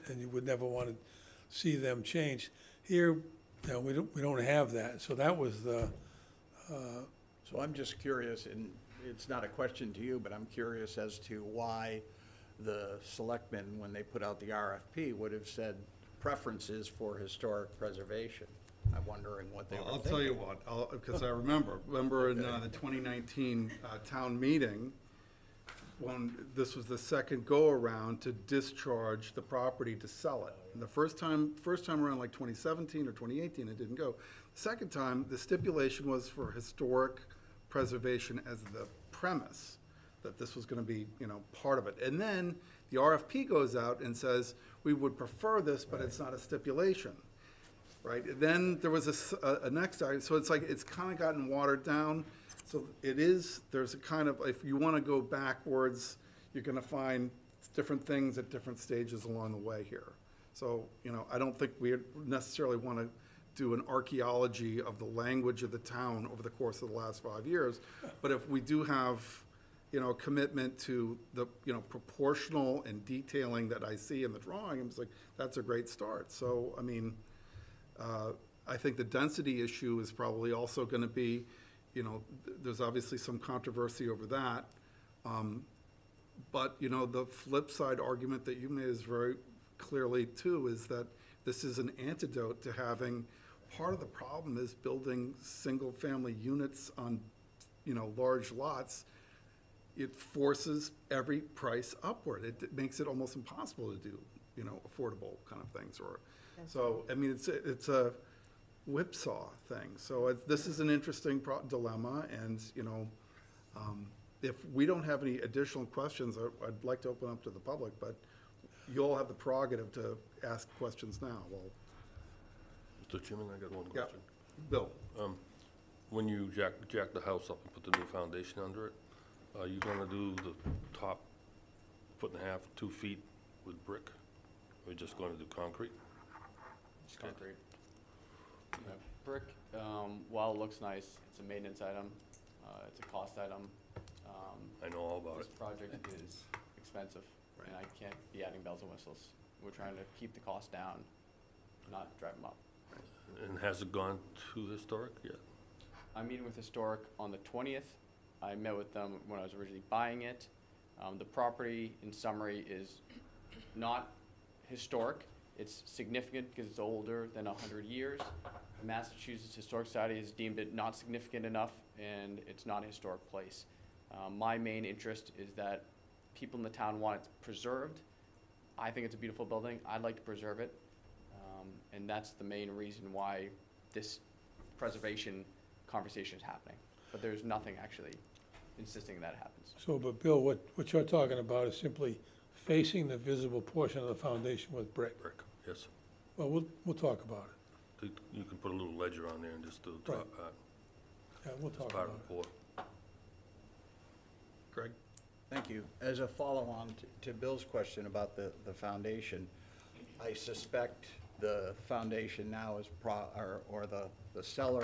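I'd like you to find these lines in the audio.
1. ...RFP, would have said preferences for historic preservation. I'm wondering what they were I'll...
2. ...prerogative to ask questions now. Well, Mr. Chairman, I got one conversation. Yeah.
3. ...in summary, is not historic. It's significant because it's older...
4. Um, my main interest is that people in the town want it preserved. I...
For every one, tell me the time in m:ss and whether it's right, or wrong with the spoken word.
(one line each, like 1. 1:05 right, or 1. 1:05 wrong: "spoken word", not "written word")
1. 0:14 right
2. 1:59 wrong: "question", not "conversation"
3. 2:42 right
4. 2:54 right.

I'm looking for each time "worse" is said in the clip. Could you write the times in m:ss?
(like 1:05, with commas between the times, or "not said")
not said.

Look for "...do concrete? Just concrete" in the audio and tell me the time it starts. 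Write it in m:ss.
2:15.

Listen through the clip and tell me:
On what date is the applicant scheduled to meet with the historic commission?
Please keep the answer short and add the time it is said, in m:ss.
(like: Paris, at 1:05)
The 20th, at 2:37.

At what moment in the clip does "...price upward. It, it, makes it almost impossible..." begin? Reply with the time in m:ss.
1:41.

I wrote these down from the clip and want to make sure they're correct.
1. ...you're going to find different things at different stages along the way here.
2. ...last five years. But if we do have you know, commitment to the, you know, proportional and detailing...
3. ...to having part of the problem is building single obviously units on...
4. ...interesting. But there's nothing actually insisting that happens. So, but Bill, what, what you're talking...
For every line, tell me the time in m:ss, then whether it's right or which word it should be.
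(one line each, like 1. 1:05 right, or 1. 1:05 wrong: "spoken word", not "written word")
1. 0:56 right
2. 1:06 right
3. 1:32 wrong: "family", not "obviously"
4. 3:06 wrong: "happening", not "interesting".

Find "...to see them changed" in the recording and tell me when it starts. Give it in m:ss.
0:00.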